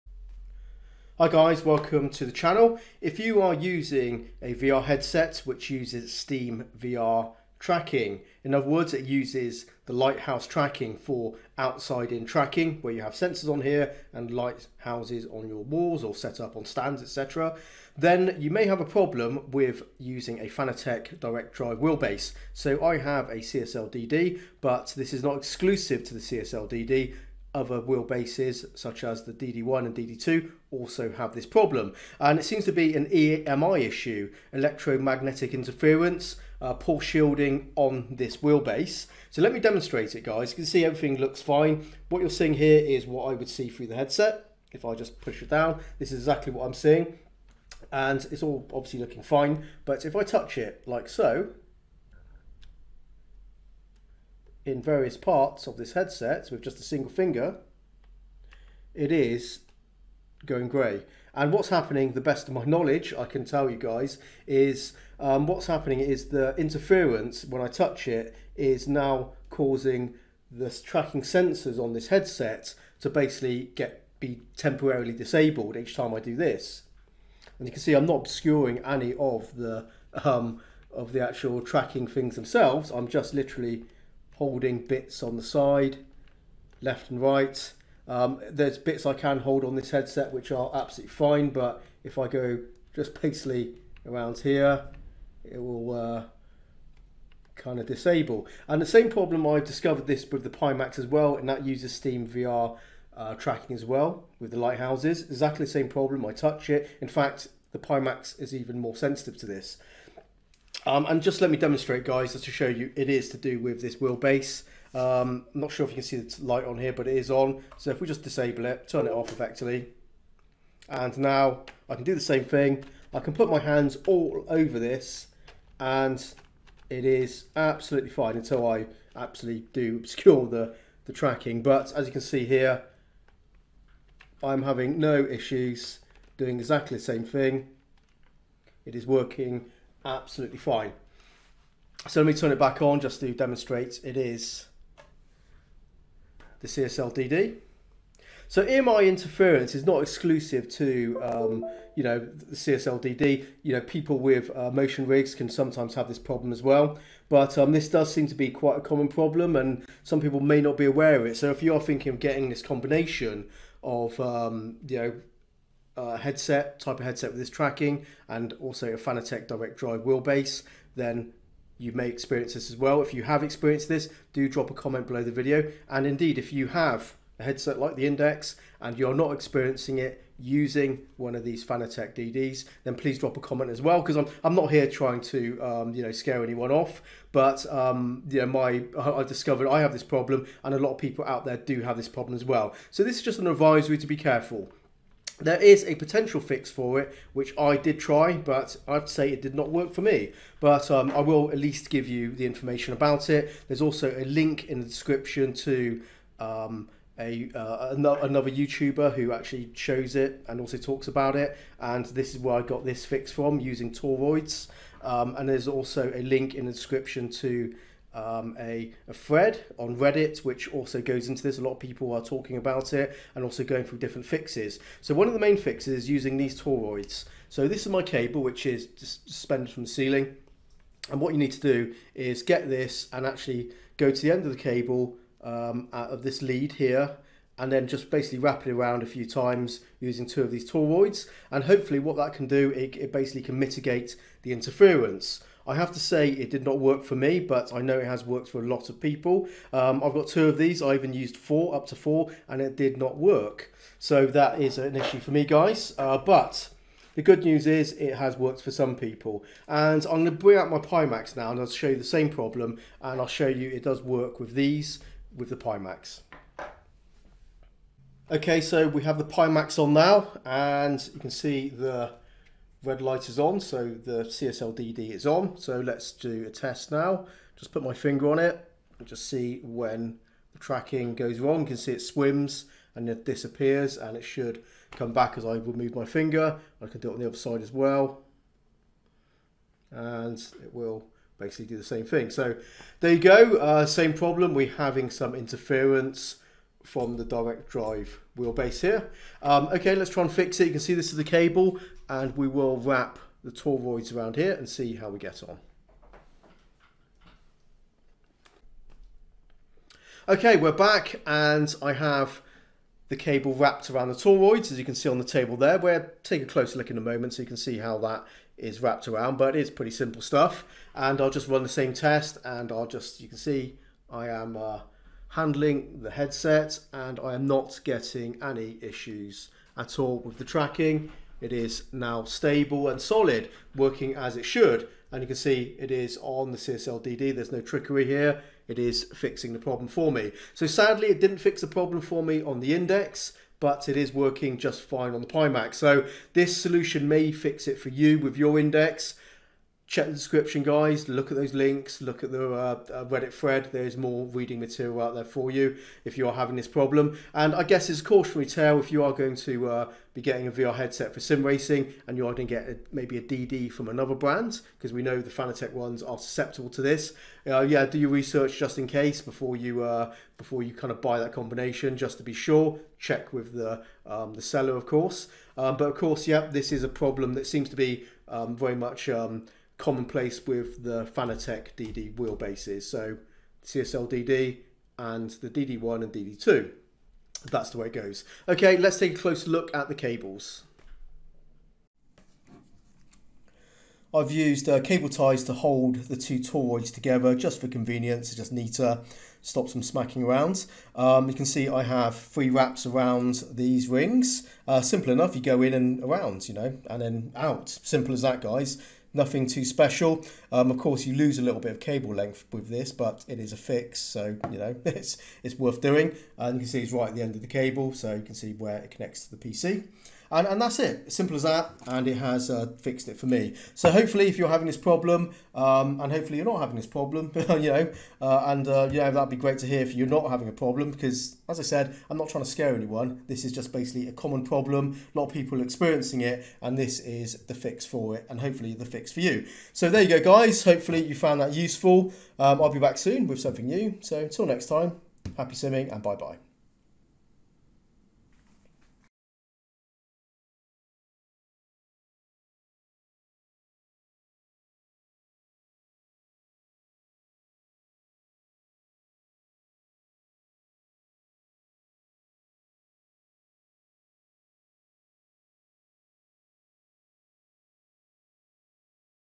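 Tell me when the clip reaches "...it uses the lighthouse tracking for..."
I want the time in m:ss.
0:08.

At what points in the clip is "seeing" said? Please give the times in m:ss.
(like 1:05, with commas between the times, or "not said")
0:42, 0:46.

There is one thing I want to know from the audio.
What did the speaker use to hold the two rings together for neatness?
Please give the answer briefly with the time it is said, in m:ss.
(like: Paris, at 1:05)
Cable ties, at 6:34.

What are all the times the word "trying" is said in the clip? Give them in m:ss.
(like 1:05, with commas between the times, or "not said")
3:04, 7:12.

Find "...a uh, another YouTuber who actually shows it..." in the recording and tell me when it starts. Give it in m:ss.
3:27.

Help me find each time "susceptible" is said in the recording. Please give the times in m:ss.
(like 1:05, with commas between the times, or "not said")
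6:06.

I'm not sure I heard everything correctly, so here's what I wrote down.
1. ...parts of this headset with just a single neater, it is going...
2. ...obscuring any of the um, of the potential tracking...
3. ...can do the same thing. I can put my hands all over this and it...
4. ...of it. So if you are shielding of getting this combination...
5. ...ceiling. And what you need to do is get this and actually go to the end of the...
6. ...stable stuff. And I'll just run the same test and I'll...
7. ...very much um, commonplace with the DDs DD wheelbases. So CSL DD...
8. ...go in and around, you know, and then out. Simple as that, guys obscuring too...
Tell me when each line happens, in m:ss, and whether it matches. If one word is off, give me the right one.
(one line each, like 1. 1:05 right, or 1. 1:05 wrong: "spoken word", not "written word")
1. 0:55 wrong: "finger", not "neater"
2. 1:18 wrong: "actual", not "potential"
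3. 2:01 right
4. 2:41 wrong: "thinking", not "shielding"
5. 3:49 right
6. 5:19 wrong: "simple", not "stable"
7. 6:18 wrong: "Fanatec", not "DDs"
8. 6:45 wrong: "nothing", not "obscuring".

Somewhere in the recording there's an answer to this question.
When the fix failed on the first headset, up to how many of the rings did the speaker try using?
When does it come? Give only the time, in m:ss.
4:11.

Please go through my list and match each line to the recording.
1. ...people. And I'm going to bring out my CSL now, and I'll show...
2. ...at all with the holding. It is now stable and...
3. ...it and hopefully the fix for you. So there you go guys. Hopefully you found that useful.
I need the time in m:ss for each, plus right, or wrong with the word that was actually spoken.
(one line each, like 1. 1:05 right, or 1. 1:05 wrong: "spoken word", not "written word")
1. 4:18 wrong: "Pimax", not "CSL"
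2. 5:29 wrong: "tracking", not "holding"
3. 7:18 right.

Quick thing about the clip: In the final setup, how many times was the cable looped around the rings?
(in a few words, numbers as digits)
3.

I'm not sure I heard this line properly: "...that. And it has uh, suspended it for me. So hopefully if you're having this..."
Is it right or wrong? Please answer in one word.
wrong.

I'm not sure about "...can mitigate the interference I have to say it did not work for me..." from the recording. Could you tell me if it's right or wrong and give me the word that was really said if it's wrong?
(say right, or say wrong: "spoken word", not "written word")
right.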